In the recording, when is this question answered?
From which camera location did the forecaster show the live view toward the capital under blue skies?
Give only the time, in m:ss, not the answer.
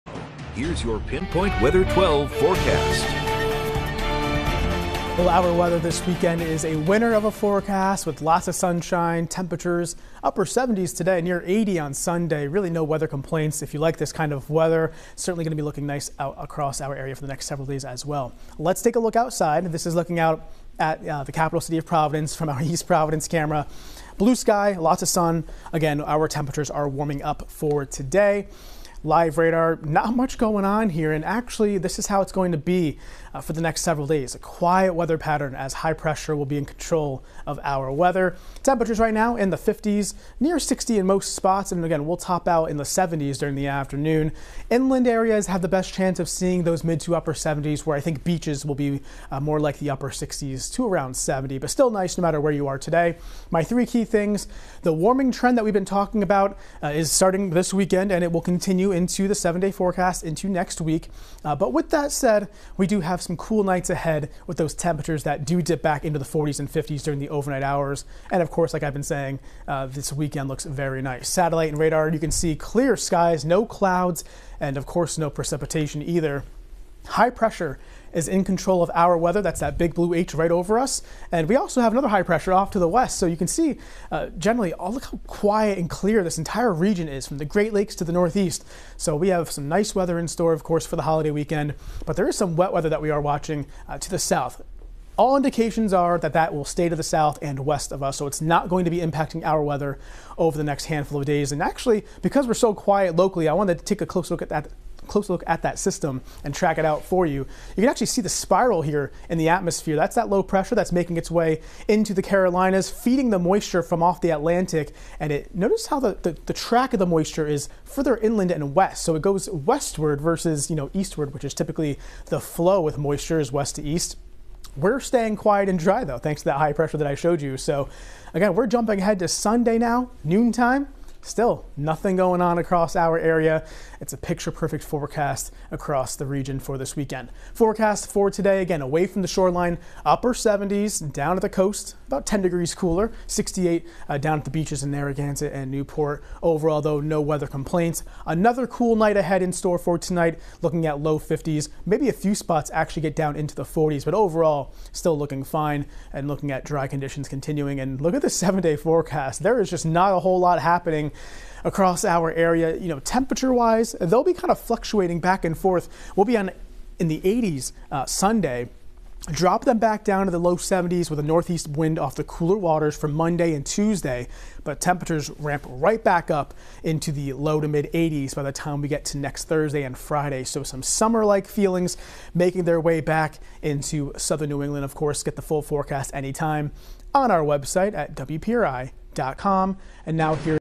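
0:22.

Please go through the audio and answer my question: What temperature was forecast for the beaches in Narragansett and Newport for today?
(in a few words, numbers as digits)
68.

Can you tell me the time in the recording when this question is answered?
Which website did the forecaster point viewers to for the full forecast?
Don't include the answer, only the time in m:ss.
3:08.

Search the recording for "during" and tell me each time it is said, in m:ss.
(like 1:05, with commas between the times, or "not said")
0:43, 1:07.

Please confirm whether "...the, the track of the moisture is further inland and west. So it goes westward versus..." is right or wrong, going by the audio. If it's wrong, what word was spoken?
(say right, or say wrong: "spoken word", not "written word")
right.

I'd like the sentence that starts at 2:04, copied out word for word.
We're staying quiet and dry though, thanks to that high pressure that I showed you.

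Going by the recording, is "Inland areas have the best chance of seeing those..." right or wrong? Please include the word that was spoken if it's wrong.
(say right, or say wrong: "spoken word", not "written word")
right.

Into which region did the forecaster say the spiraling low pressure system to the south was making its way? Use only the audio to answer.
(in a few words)
the Carolinas.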